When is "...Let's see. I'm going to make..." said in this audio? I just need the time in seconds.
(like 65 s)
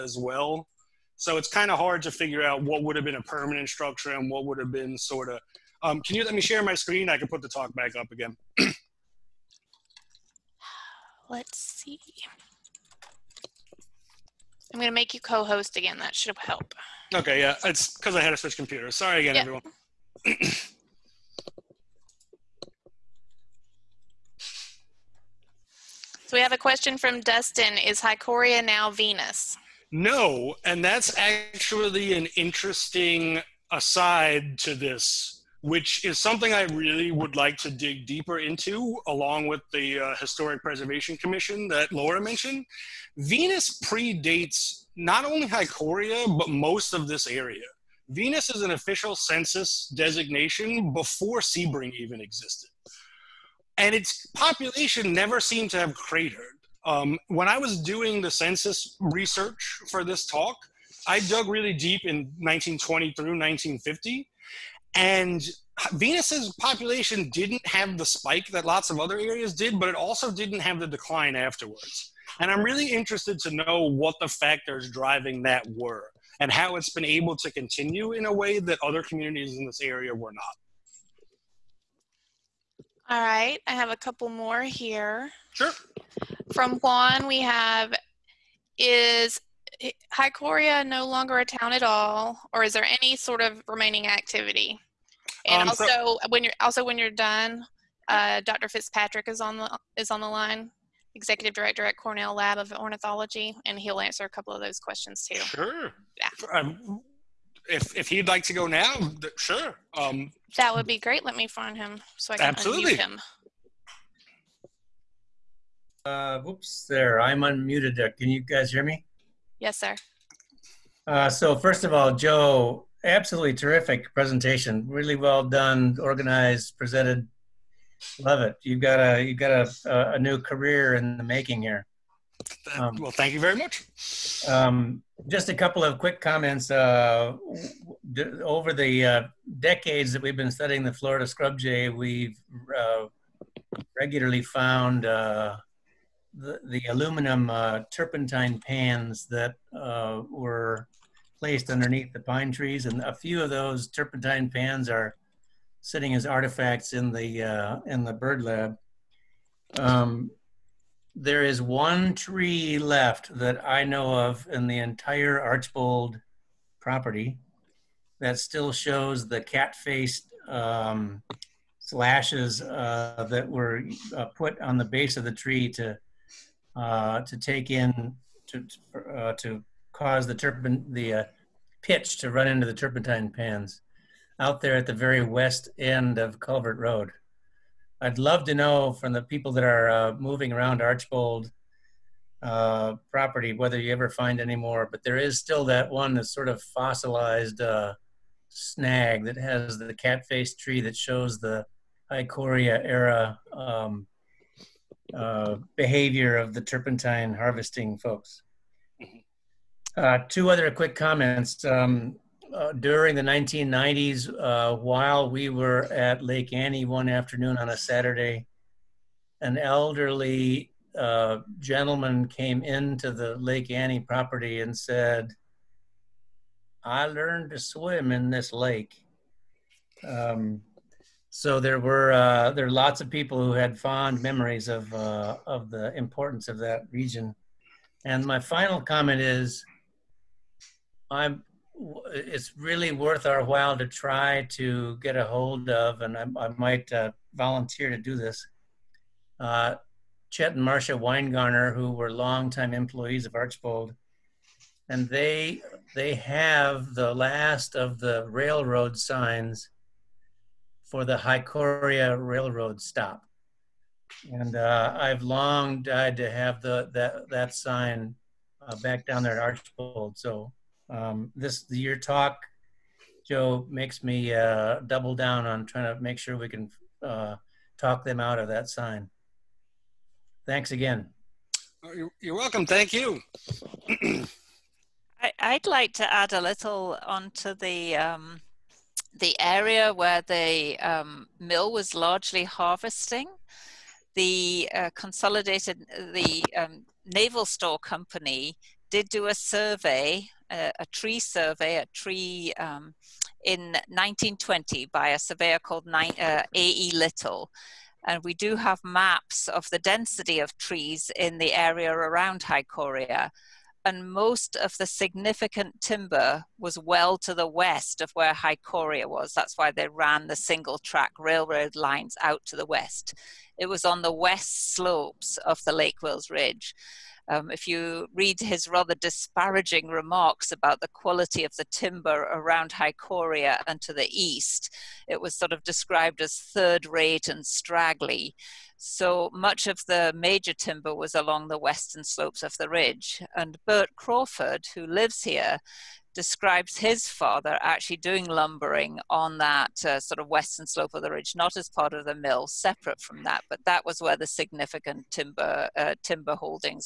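11 s.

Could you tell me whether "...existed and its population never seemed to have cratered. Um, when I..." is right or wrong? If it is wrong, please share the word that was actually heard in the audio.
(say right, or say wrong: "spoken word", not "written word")
right.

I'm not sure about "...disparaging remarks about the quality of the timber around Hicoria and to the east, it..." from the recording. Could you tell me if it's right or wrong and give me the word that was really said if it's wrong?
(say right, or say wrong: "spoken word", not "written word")
right.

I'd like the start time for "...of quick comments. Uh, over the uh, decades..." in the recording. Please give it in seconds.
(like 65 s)
135 s.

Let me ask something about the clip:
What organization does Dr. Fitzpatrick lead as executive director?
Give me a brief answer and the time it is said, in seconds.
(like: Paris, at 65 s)
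Cornell Lab of Ornithology, at 101 s.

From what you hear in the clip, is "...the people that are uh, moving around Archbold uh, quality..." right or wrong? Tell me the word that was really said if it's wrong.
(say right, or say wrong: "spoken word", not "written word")
wrong: "property", not "quality".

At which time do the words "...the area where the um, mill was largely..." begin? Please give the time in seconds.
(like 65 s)
289 s.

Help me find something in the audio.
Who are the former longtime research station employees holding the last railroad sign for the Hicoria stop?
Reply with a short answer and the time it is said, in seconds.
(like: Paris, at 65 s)
Chet and Marcia Winegarner, at 250 s.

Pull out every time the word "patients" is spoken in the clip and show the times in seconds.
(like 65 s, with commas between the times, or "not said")
not said.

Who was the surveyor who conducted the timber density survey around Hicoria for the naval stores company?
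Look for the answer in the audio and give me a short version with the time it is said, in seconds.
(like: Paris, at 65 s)
A.E. Little, at 306 s.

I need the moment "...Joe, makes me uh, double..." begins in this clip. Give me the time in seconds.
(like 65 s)
273 s.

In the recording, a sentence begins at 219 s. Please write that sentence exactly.
An elderly uh, gentleman came into the Lake Annie property and said, I learned to swim in this lake.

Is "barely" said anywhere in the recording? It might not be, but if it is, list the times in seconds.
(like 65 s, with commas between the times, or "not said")
not said.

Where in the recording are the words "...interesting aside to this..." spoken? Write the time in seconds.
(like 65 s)
32 s.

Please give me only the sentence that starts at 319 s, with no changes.
That's why they ran the single track railroad lines out to the west.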